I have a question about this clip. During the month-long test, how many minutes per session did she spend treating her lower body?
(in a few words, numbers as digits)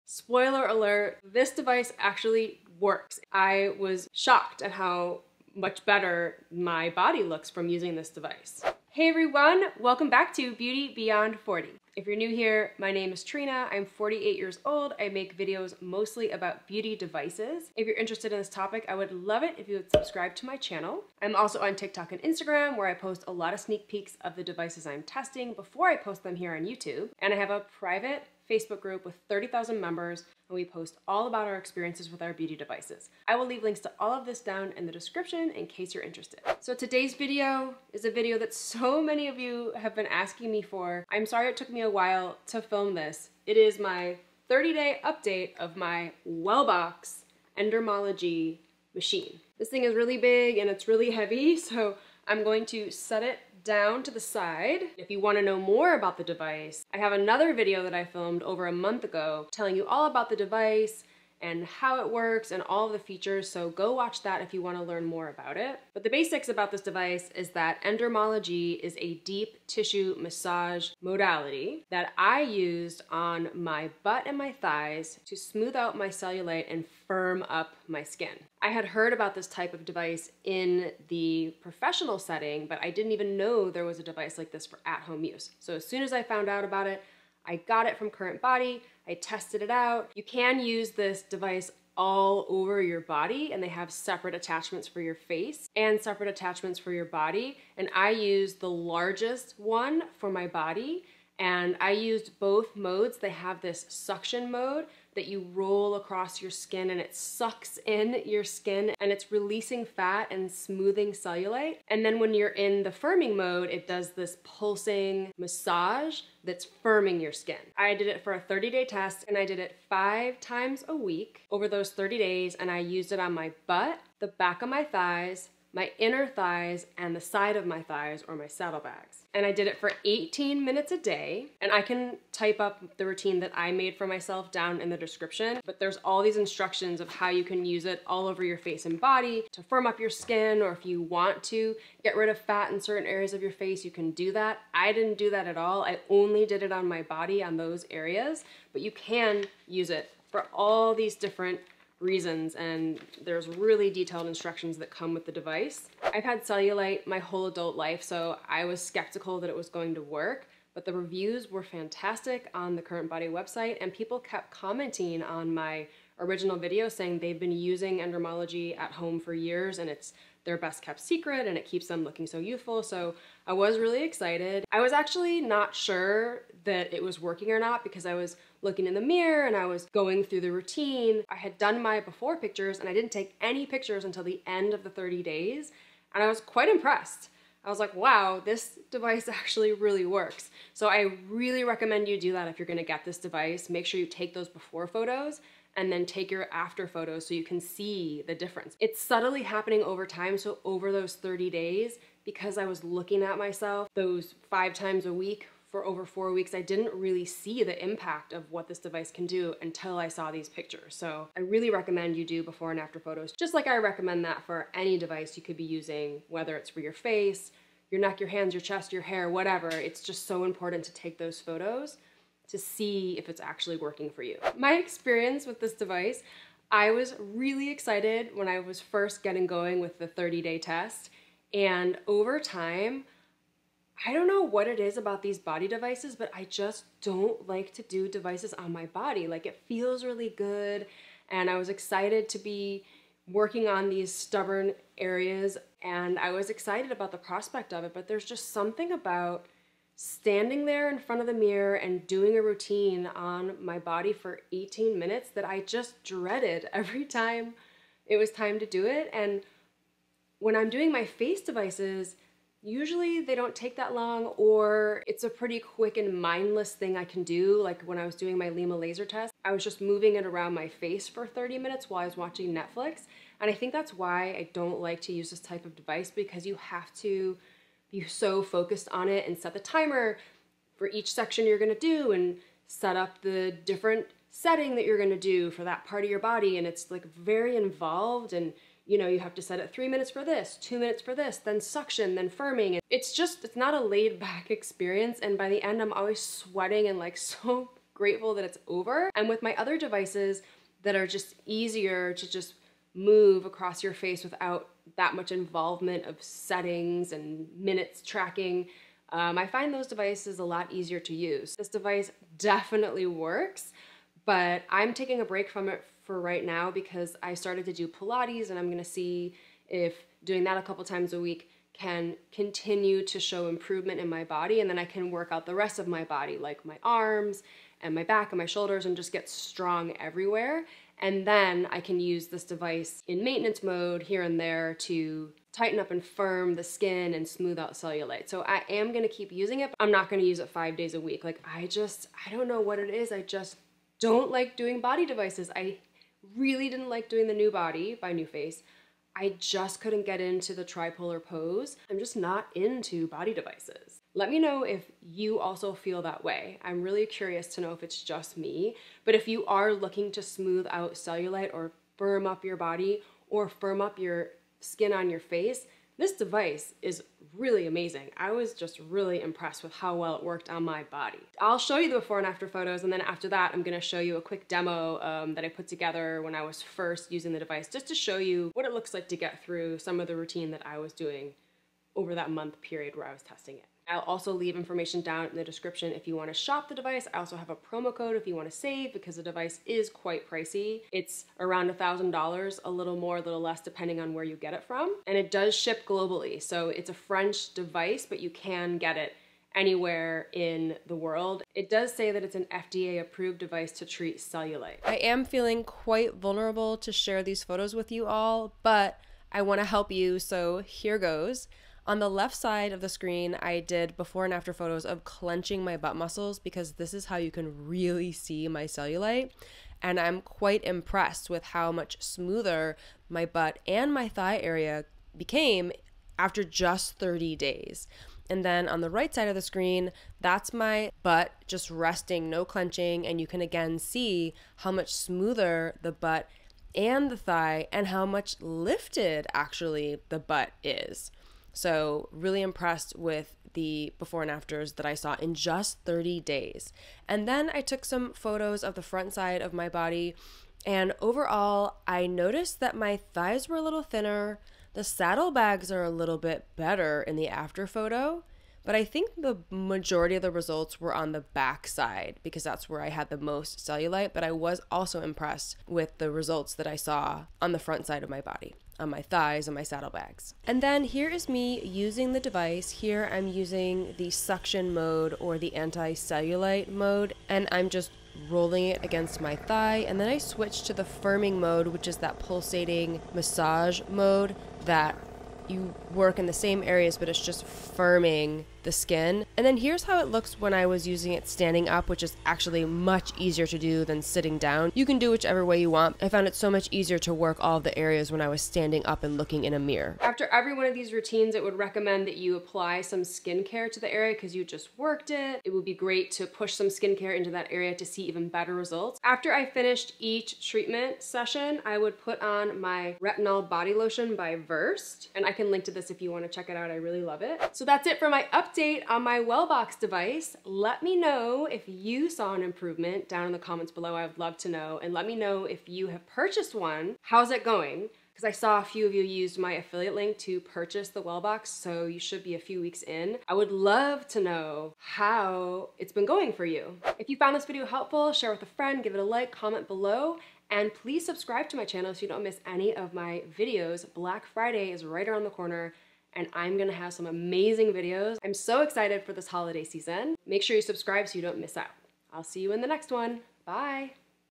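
18 minutes.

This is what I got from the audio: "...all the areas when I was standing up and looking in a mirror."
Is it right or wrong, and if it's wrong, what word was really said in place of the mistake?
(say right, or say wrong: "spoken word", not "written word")
right.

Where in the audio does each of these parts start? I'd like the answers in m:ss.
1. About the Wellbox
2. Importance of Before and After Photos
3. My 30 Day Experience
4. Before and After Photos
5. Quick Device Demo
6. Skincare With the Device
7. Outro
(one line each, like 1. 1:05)
1. 0:45
2. 3:20
3. 3:45
4. 6:45
5. 7:51
6. 8:20
7. 8:37.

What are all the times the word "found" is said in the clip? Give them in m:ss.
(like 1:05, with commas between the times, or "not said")
1:26, 8:16, 8:57.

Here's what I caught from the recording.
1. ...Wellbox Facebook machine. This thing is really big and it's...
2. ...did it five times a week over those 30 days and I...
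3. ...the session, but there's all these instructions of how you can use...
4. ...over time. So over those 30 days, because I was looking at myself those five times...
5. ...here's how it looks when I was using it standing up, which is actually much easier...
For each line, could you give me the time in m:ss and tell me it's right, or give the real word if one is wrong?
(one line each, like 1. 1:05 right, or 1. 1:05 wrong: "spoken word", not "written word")
1. 0:46 wrong: "Endermologie", not "Facebook"
2. 1:59 right
3. 2:14 wrong: "description", not "session"
4. 3:19 right
5. 8:09 right.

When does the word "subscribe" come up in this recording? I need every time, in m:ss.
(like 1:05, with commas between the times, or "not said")
0:19, 9:01, 9:10.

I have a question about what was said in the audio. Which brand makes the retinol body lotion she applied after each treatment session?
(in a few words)
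Versed.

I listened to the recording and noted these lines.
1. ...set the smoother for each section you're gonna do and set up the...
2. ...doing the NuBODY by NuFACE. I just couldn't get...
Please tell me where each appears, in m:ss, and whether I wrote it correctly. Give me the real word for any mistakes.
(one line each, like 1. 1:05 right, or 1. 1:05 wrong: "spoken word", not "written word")
1. 4:39 wrong: "timer", not "smoother"
2. 5:47 right.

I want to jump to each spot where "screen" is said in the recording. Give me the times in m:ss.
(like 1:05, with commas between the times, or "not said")
6:52, 7:09.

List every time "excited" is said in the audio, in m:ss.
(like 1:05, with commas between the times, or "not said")
2:54, 3:47, 4:01, 4:06, 9:08.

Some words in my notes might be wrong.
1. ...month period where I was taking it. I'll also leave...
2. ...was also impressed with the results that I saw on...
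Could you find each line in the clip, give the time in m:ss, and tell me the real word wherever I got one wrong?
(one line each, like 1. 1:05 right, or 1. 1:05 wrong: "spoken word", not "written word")
1. 6:22 wrong: "testing", not "taking"
2. 7:44 right.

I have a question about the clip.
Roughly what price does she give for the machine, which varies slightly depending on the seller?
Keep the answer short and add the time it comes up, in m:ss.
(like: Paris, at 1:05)
$1,000, at 6:31.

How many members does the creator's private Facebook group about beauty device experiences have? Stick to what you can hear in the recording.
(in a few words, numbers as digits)
30,000.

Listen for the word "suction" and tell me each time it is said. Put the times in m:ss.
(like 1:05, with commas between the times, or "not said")
1:43, 4:51, 7:54.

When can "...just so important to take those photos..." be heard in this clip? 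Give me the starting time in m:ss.
3:40.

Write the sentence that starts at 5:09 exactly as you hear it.
Um, I find those devices a lot easier to use.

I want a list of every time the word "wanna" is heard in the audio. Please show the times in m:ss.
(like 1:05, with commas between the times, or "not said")
0:55, 1:04, 8:36.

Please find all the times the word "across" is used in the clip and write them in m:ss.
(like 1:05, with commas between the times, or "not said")
1:45, 5:03.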